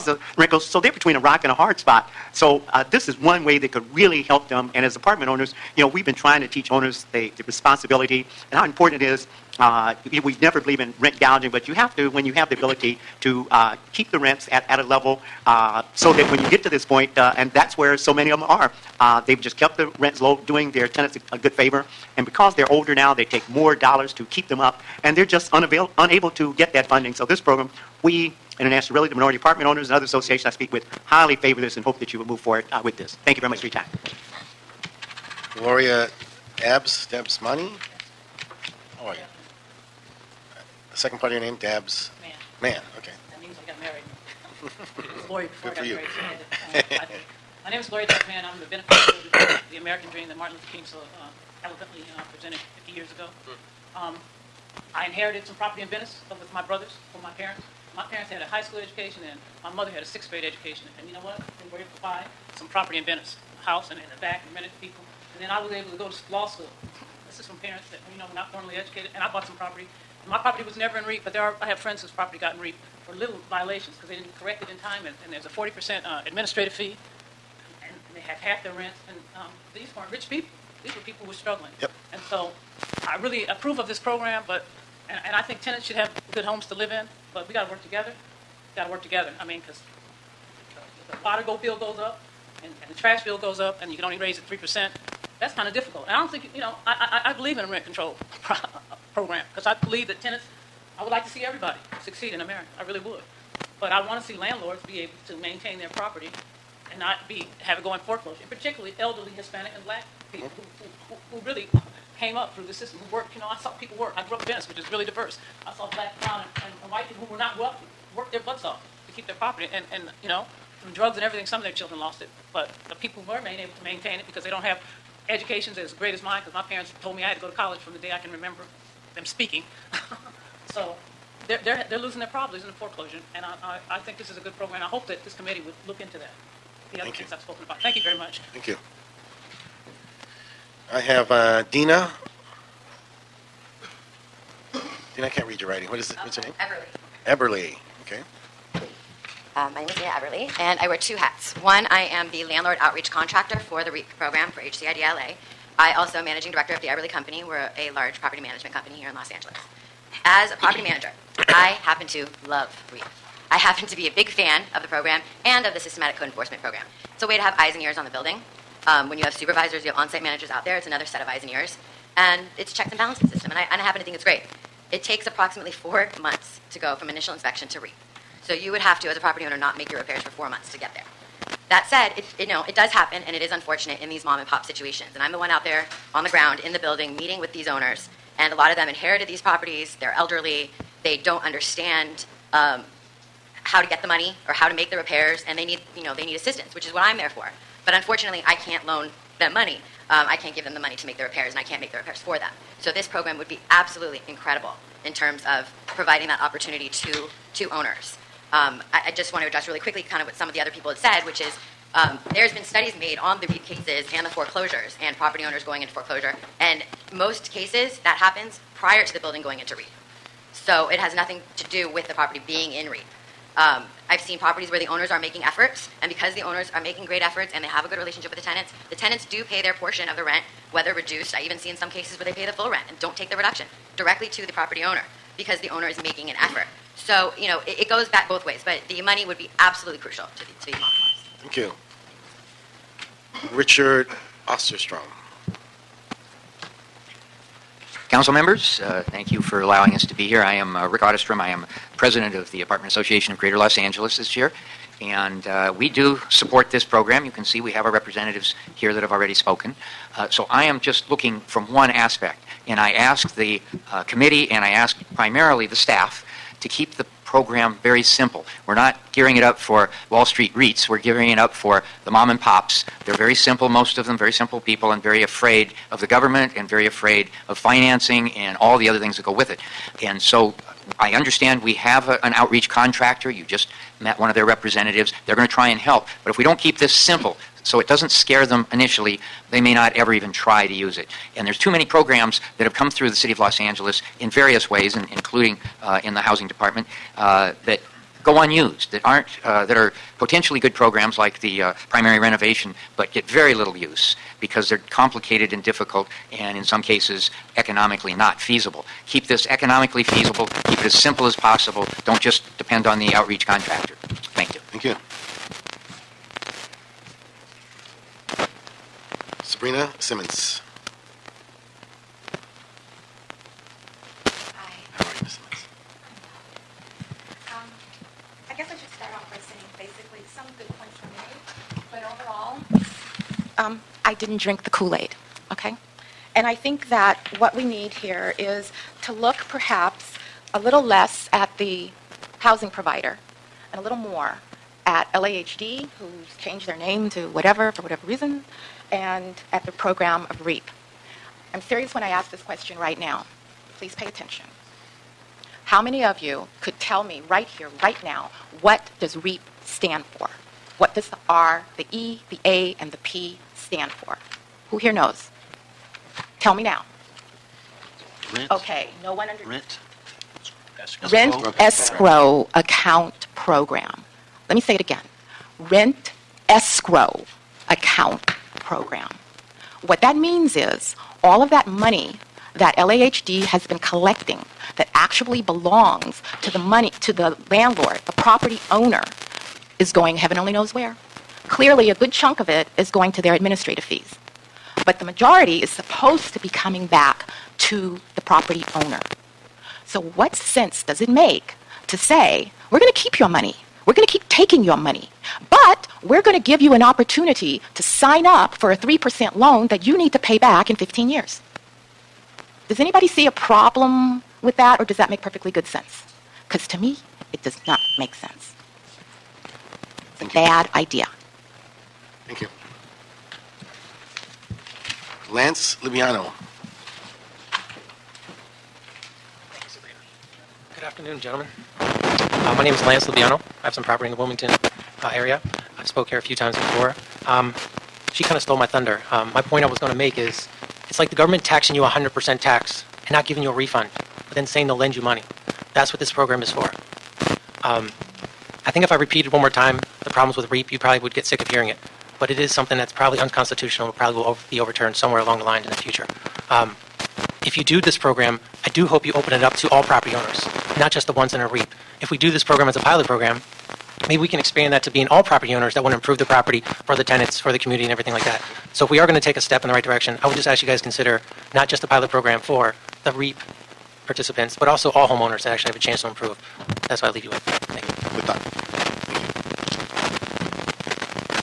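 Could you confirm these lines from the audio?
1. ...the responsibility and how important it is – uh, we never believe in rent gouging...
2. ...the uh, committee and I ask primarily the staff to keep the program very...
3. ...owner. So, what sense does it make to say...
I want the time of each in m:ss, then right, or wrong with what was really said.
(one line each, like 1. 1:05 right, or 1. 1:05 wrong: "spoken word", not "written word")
1. 0:07 right
2. 4:23 right
3. 6:38 right.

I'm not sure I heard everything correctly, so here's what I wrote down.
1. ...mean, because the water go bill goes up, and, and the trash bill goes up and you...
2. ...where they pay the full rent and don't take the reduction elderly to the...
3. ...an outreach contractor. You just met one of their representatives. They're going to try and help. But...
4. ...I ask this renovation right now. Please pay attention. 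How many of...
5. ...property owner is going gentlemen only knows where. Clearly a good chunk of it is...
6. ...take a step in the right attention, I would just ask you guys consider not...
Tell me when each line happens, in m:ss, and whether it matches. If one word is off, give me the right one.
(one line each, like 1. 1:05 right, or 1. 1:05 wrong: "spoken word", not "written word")
1. 1:29 right
2. 3:52 wrong: "directly", not "elderly"
3. 4:42 right
4. 5:52 wrong: "question", not "renovation"
5. 6:28 wrong: "heaven", not "gentlemen"
6. 7:49 wrong: "direction", not "attention".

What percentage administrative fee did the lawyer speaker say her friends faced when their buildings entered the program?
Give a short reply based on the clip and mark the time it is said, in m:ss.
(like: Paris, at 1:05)
40%, at 1:15.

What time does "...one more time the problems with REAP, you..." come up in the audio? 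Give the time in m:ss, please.
7:29.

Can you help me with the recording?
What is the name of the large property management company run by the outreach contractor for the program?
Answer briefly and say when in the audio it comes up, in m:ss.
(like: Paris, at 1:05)
The Everly Company, at 2:36.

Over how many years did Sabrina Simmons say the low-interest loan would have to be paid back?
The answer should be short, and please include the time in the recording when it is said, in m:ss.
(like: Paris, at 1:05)
15 years, at 6:50.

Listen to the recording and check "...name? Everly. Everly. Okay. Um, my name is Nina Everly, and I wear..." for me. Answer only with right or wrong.
right.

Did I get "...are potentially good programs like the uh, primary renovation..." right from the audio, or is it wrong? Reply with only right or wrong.
right.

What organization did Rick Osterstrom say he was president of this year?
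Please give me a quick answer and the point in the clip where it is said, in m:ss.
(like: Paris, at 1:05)
Apartment Association of Greater Los Angeles, at 4:12.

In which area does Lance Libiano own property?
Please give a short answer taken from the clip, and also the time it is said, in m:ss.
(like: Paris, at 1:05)
Wilmington, at 7:14.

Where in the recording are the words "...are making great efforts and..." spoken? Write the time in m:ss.
3:46.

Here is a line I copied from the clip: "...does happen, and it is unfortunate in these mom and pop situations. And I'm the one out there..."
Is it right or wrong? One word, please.
right.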